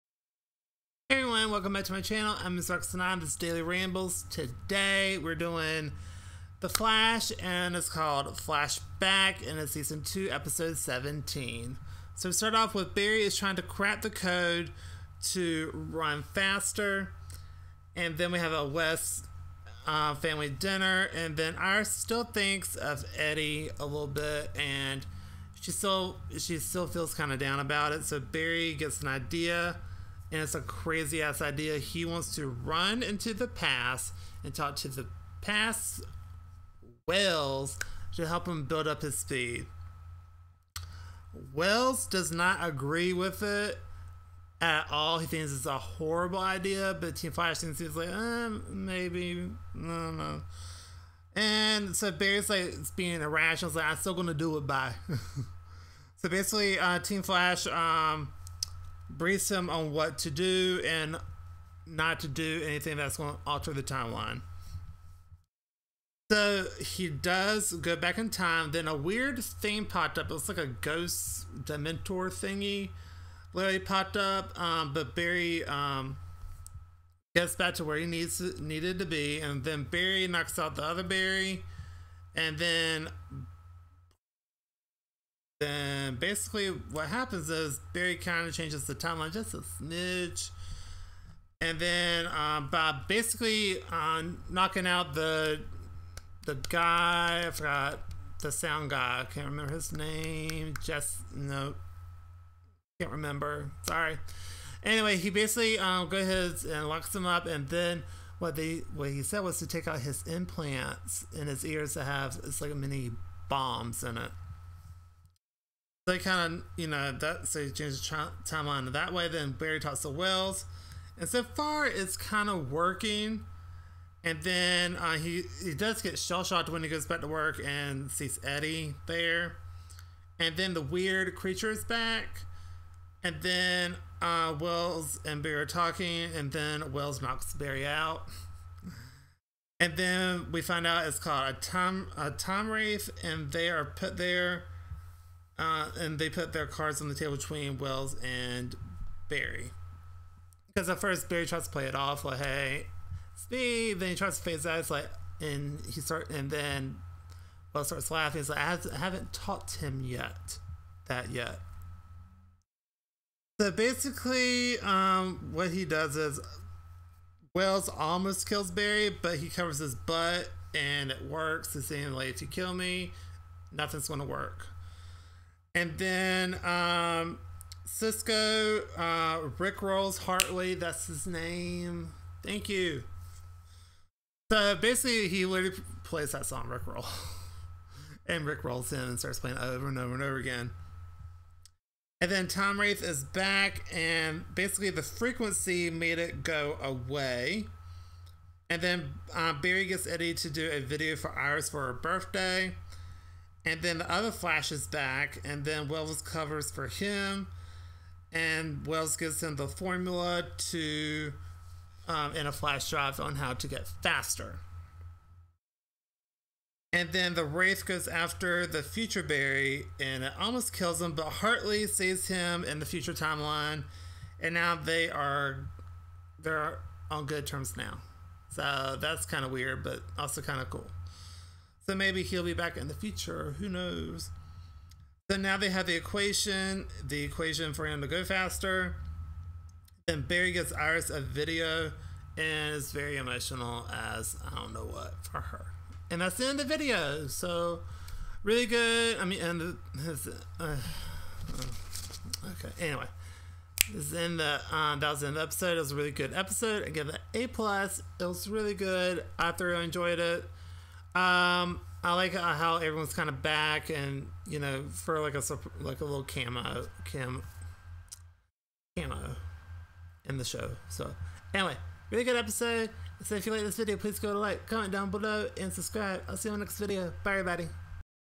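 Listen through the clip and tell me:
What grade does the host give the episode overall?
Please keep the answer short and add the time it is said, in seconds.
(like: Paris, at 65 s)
A plus, at 257 s.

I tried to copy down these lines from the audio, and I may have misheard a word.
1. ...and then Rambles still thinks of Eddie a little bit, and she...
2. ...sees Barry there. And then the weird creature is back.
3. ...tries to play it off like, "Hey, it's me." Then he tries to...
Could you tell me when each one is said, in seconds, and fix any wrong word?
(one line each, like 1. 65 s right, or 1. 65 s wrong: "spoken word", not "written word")
1. 21 s wrong: "Iris", not "Rambles"
2. 128 s wrong: "Eddie", not "Barry"
3. 151 s right.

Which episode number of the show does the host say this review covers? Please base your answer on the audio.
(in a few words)
17.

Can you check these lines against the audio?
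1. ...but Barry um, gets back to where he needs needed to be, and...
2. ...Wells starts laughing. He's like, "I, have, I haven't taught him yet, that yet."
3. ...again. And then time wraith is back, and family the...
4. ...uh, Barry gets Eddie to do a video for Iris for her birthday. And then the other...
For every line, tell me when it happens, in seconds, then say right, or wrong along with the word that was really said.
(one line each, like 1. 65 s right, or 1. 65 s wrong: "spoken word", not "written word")
1. 74 s right
2. 157 s right
3. 190 s wrong: "basically", not "family"
4. 199 s right.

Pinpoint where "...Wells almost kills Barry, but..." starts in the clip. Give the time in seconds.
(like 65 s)
167 s.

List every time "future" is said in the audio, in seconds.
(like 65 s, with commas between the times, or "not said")
218 s, 222 s, 232 s.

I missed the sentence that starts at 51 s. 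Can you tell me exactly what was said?
And so Barry's like, it's being irrational.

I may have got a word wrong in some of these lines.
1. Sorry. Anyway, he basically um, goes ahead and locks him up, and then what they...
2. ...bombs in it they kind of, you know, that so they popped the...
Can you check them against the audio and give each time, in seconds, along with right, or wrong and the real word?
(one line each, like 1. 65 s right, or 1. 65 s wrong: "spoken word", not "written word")
1. 103 s right
2. 113 s wrong: "changed", not "popped".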